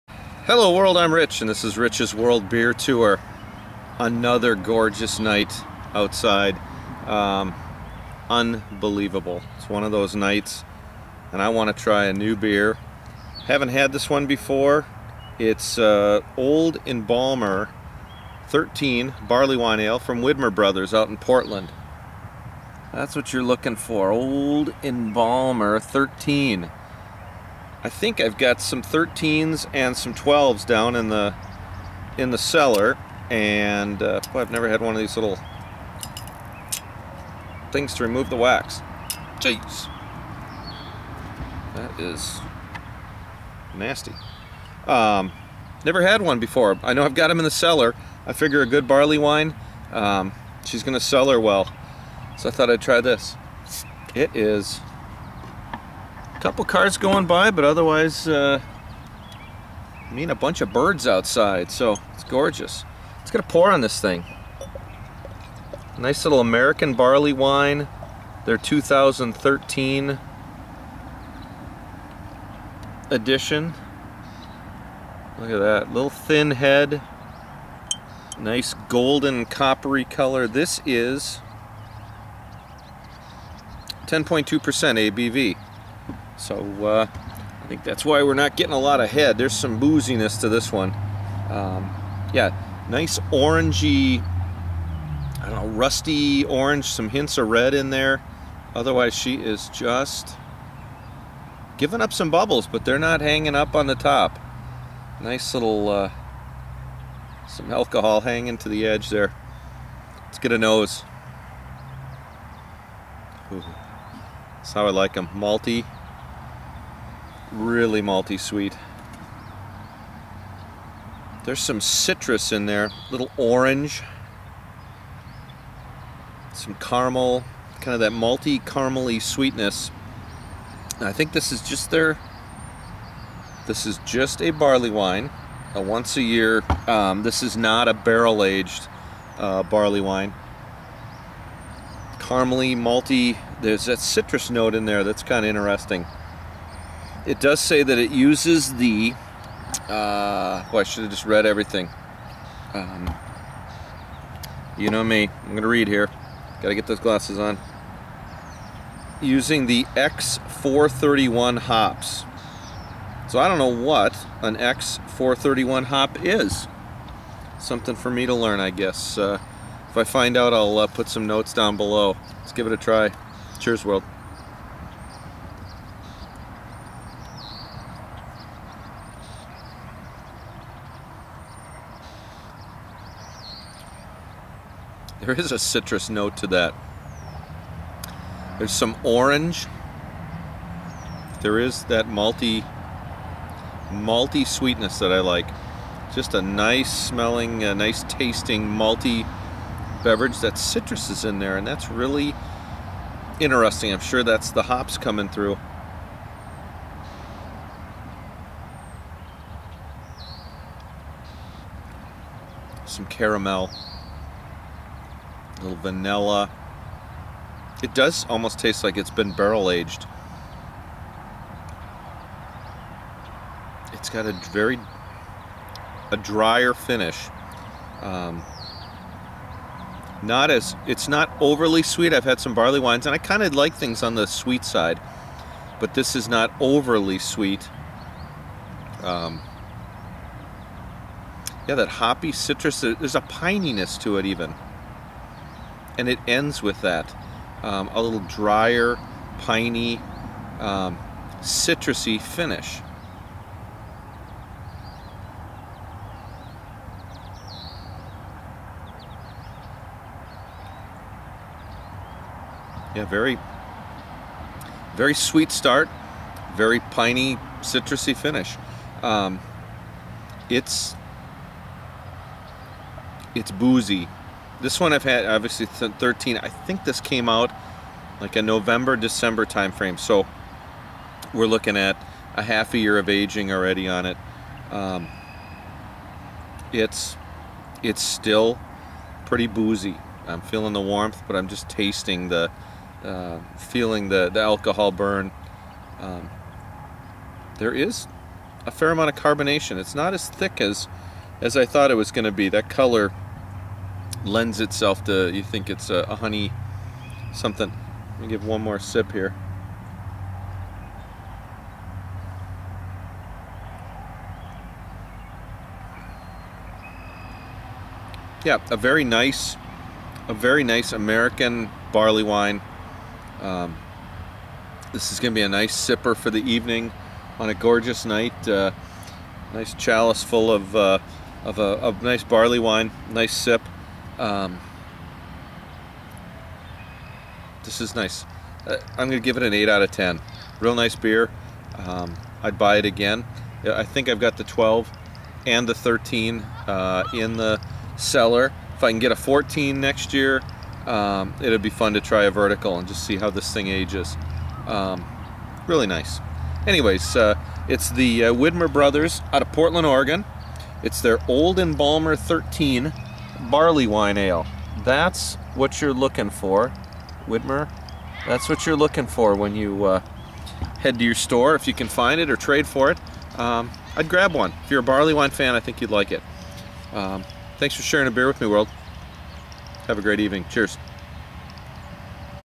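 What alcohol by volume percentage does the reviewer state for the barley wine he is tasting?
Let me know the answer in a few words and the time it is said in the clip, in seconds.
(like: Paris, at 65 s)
10.2%, at 84 s.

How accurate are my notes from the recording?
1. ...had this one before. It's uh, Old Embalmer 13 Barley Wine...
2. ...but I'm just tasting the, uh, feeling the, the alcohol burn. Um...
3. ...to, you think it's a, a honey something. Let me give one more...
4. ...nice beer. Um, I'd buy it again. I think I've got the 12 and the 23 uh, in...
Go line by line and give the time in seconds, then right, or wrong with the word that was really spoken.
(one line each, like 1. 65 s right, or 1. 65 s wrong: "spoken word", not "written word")
1. 13 s right
2. 291 s right
3. 305 s right
4. 340 s wrong: "13", not "23".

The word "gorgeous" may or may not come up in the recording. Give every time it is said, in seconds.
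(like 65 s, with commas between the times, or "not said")
4 s, 62 s, 327 s.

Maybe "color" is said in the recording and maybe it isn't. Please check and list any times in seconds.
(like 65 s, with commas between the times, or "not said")
80 s, 302 s.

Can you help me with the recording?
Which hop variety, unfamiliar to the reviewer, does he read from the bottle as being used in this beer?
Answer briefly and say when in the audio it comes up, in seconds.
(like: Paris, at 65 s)
X431, at 159 s.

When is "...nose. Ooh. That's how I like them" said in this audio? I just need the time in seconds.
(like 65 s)
110 s.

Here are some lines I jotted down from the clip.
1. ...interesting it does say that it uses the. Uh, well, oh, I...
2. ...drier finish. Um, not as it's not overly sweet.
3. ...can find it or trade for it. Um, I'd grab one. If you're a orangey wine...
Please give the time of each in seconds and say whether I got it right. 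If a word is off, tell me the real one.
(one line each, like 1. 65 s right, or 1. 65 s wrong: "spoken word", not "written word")
1. 145 s right
2. 226 s right
3. 371 s wrong: "barley", not "orangey".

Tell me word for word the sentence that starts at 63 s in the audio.
It's gonna pour on this thing.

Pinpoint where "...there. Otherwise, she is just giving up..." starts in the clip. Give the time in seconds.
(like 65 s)
97 s.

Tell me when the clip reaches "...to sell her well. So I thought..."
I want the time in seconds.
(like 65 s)
50 s.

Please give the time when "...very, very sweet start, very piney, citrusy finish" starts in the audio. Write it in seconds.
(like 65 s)
263 s.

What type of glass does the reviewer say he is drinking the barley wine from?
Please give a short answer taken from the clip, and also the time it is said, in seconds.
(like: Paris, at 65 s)
Chalice, at 329 s.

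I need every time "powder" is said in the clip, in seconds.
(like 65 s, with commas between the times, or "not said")
not said.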